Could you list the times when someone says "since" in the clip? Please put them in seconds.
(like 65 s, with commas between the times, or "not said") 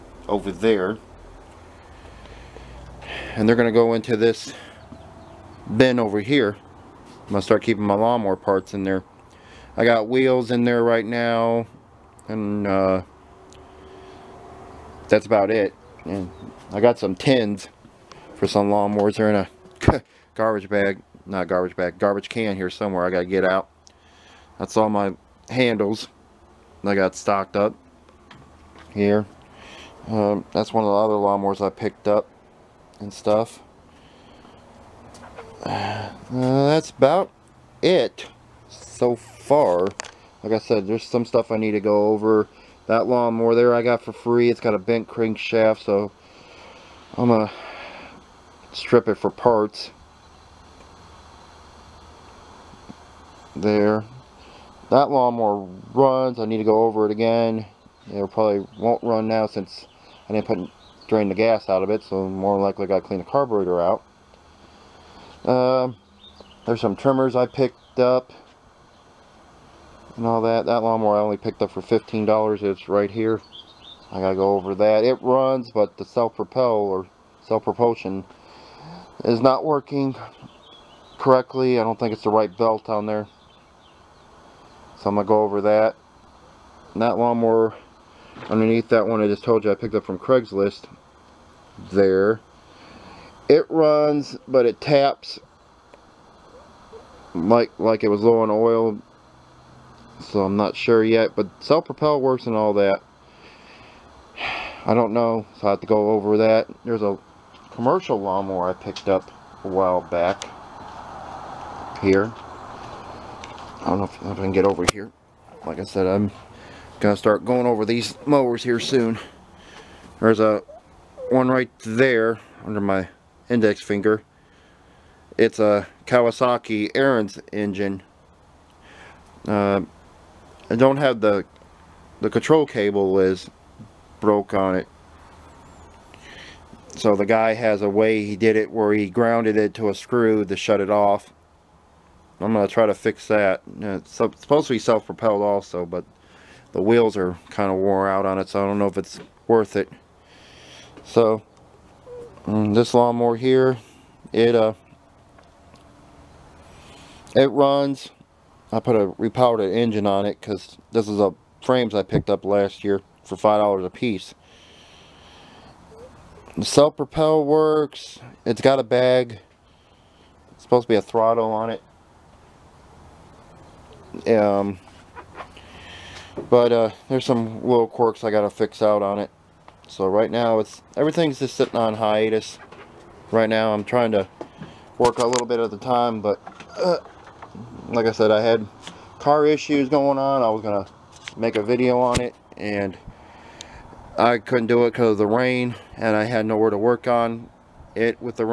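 59 s.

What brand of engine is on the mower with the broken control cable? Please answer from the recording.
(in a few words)
Kawasaki.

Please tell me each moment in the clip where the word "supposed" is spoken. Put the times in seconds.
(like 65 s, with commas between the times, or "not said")
144 s, 170 s.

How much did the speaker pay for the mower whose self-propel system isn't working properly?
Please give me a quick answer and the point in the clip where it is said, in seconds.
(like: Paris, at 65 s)
$15, at 71 s.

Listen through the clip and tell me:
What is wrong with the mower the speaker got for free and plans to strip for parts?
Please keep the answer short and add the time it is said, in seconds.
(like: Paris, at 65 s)
Bent crankshaft, at 44 s.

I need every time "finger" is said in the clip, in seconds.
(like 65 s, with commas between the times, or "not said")
123 s.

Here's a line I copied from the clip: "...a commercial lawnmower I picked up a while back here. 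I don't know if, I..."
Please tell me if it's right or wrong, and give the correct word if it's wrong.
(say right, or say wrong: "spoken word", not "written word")
right.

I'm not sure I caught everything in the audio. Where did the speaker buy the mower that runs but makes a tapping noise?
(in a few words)
Craigslist.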